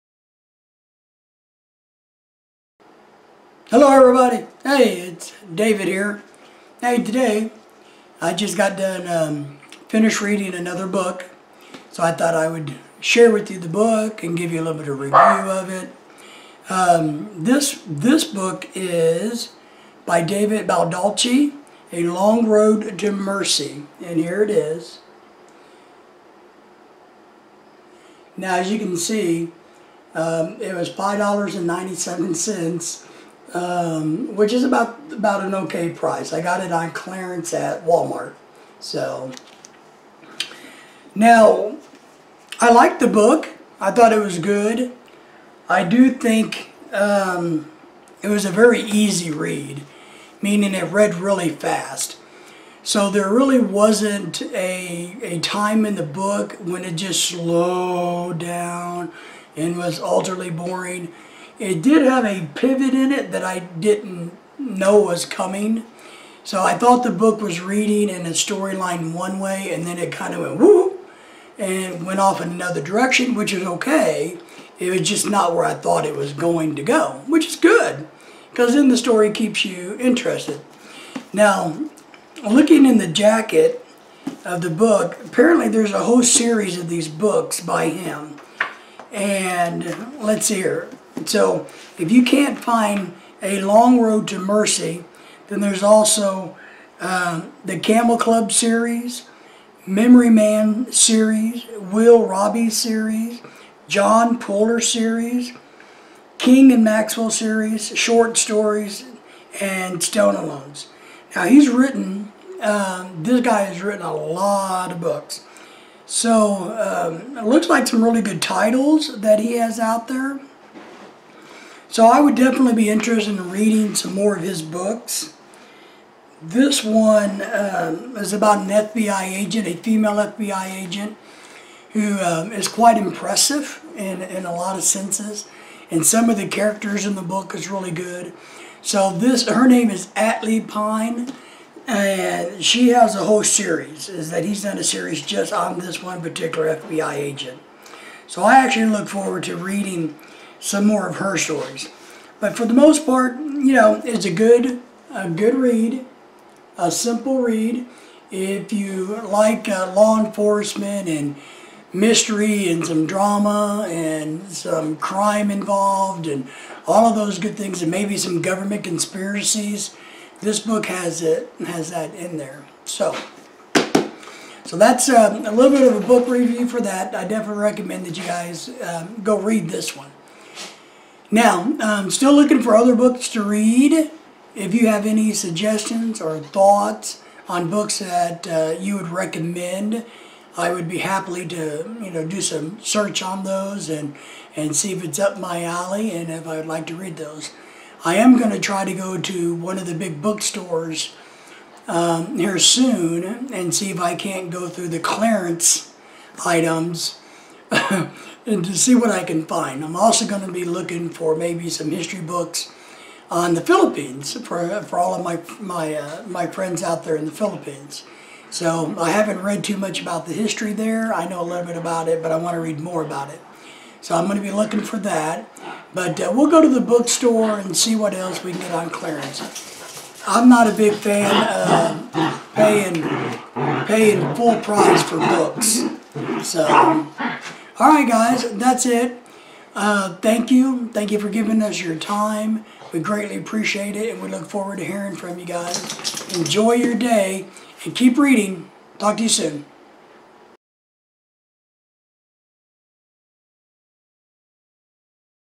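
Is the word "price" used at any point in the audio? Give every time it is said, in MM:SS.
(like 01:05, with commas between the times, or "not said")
00:35, 03:54.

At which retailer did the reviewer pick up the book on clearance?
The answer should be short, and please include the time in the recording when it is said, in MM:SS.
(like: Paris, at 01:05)
Walmart, at 00:37.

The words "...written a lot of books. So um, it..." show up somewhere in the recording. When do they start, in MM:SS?
01:53.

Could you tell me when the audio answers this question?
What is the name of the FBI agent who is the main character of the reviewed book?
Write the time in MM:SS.
02:20.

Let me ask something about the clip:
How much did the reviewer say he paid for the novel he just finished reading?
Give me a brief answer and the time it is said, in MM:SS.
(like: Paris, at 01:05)
$5.97, at 00:30.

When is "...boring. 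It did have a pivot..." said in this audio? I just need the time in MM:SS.
01:00.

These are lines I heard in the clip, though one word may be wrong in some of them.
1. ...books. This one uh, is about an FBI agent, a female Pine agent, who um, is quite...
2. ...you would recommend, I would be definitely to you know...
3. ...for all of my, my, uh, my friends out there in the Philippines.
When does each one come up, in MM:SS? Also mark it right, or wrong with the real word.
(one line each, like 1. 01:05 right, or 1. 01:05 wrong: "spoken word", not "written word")
1. 02:04 wrong: "FBI", not "Pine"
2. 03:08 wrong: "happily", not "definitely"
3. 03:34 right.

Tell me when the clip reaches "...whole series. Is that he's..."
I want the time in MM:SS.
02:23.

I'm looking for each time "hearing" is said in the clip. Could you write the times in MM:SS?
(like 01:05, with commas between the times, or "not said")
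04:04.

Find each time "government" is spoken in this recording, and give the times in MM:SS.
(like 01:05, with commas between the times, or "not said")
02:48.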